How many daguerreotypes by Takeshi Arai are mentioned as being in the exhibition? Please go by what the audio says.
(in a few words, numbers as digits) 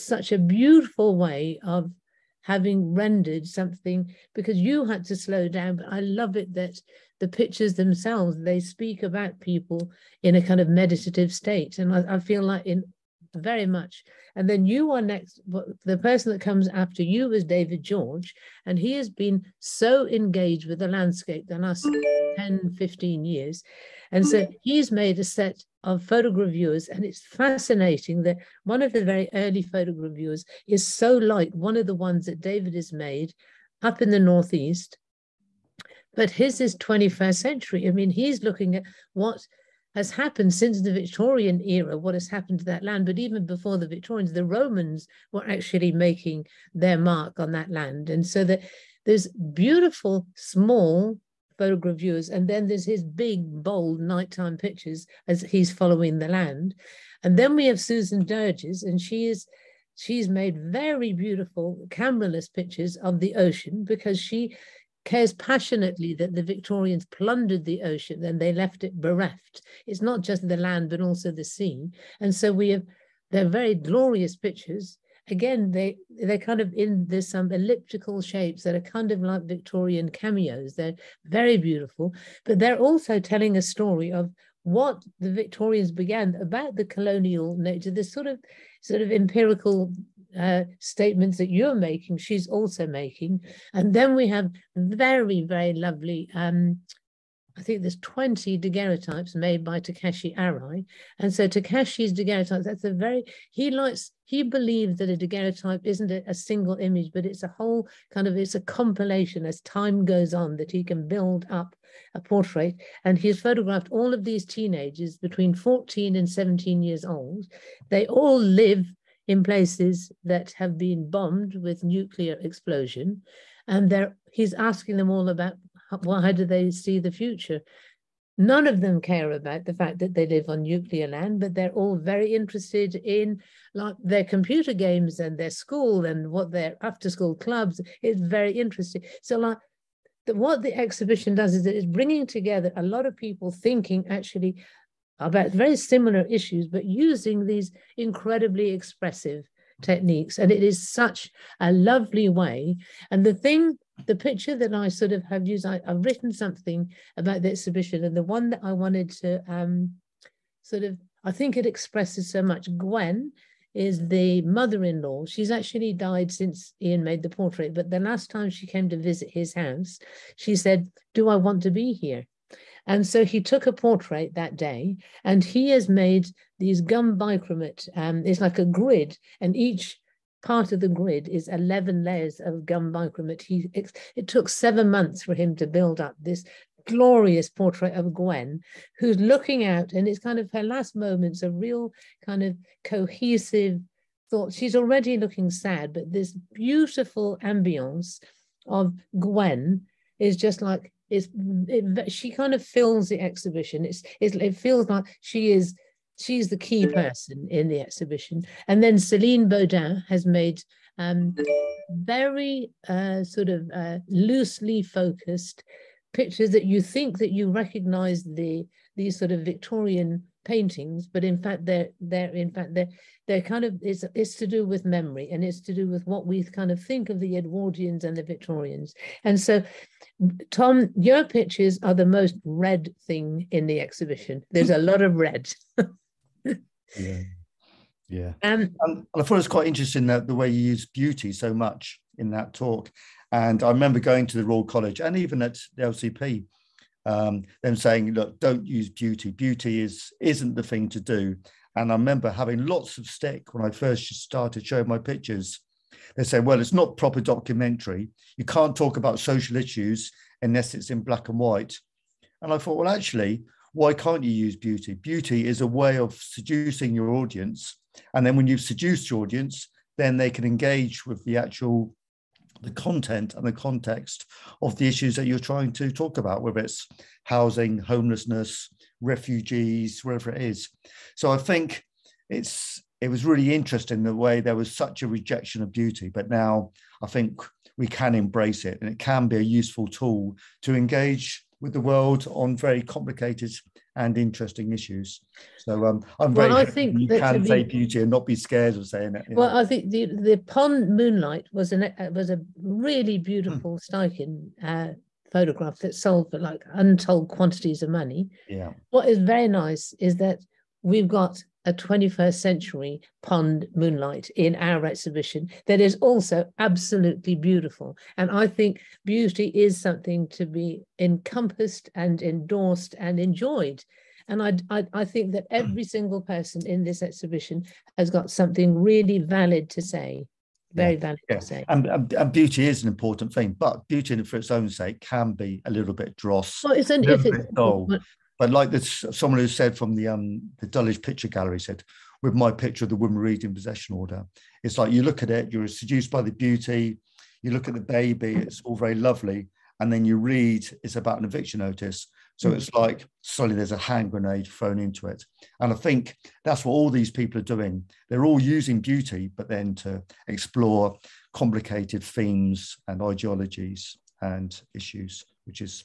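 20.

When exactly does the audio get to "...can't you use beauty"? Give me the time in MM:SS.
04:23.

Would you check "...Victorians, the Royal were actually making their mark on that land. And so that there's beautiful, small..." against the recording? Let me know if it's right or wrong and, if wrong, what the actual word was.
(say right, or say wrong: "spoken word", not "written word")
wrong: "Romans", not "Royal".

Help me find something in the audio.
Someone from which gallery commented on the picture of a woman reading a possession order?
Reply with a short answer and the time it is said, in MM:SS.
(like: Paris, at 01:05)
Dulwich Picture Gallery, at 05:40.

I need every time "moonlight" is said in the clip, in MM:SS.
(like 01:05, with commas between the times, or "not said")
05:00, 05:13.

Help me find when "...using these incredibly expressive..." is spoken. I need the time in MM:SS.
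02:26.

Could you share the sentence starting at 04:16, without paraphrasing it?
They say, well, it's not proper documentary.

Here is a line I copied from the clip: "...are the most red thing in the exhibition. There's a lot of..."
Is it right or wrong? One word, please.
right.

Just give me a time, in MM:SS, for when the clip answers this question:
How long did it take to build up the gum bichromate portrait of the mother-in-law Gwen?
03:04.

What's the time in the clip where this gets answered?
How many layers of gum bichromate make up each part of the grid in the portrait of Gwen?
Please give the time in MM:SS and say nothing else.
03:01.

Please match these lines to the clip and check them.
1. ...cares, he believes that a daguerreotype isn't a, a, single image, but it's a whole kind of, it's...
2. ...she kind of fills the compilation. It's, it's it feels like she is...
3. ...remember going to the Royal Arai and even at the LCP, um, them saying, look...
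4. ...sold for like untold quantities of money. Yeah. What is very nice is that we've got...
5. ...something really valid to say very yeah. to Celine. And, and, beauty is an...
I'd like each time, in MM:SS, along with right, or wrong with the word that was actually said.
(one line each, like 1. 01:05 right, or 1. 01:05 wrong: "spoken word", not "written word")
1. 01:43 wrong: "likes", not "cares"
2. 03:22 wrong: "exhibition", not "compilation"
3. 04:03 wrong: "College", not "Arai"
4. 05:05 right
5. 05:28 wrong: "Say", not "Celine".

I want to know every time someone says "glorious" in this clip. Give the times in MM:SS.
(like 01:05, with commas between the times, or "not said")
01:13, 03:06.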